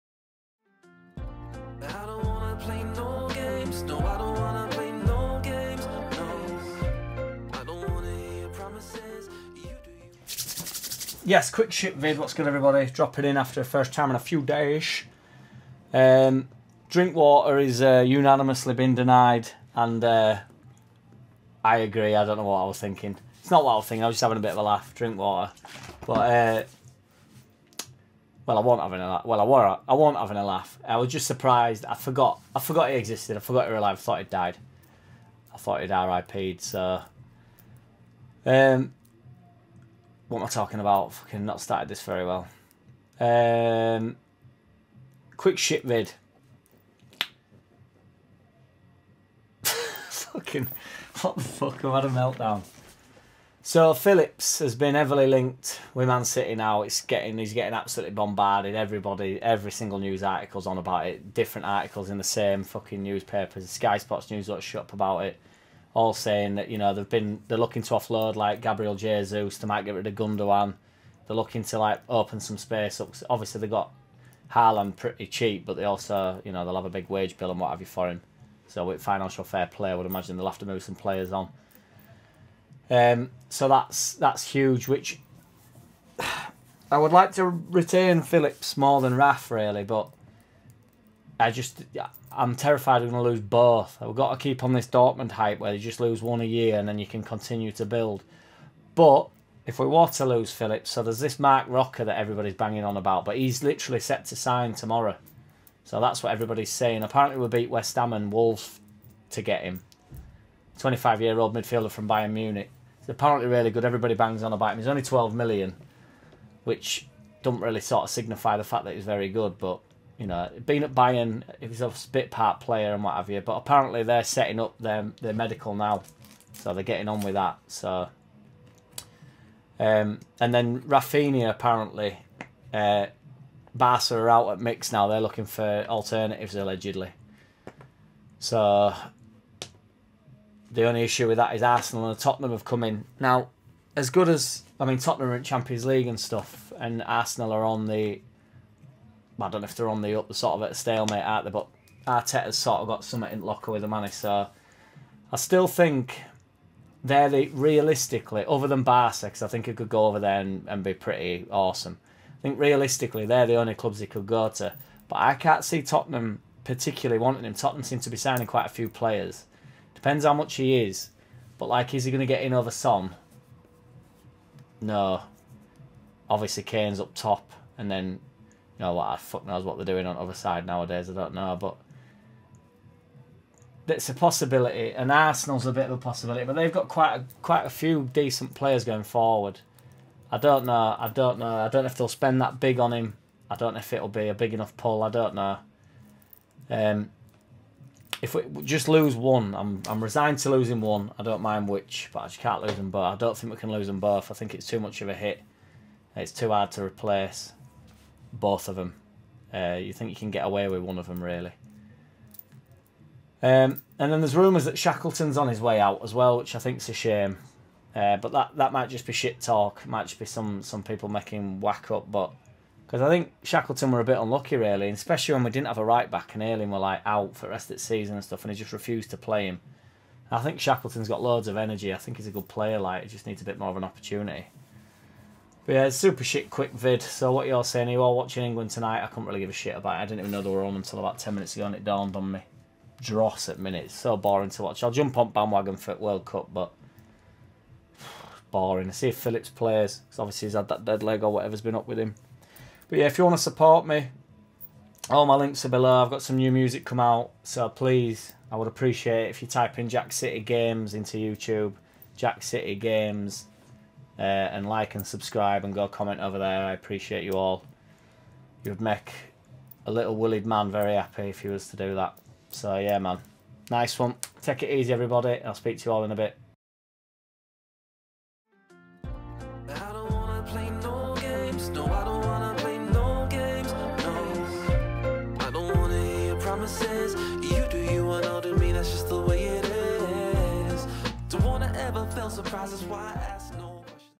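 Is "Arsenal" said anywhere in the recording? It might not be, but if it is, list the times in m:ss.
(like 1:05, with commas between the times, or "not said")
2:21, 2:27, 3:05.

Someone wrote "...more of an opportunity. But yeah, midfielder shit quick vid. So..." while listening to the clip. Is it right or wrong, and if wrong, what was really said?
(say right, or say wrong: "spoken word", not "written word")
wrong: "super", not "midfielder".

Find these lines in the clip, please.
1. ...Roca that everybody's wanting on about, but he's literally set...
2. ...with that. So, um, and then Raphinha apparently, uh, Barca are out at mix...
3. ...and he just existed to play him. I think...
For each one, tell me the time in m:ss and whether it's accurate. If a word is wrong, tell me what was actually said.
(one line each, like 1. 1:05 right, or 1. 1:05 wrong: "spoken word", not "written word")
1. 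1:41 wrong: "banging", not "wanting"
2. 2:07 right
3. 3:48 wrong: "refused", not "existed".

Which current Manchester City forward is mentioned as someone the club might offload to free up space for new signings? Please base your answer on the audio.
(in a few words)
Gabriel Jesus.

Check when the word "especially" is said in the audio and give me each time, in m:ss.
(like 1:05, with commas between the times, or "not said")
3:44.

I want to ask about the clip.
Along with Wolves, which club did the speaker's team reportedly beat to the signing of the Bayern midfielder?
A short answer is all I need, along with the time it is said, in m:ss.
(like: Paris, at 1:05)
West Ham, at 1:47.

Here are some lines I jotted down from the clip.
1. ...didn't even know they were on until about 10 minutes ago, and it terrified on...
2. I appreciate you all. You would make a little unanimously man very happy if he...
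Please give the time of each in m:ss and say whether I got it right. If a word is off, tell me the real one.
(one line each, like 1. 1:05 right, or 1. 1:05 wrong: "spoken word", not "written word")
1. 4:00 wrong: "dawned", not "terrified"
2. 4:26 wrong: "woolly", not "unanimously".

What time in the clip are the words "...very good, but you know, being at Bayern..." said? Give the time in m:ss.
1:59.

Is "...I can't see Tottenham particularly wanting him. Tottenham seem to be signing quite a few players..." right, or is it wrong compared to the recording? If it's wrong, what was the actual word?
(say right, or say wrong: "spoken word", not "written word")
right.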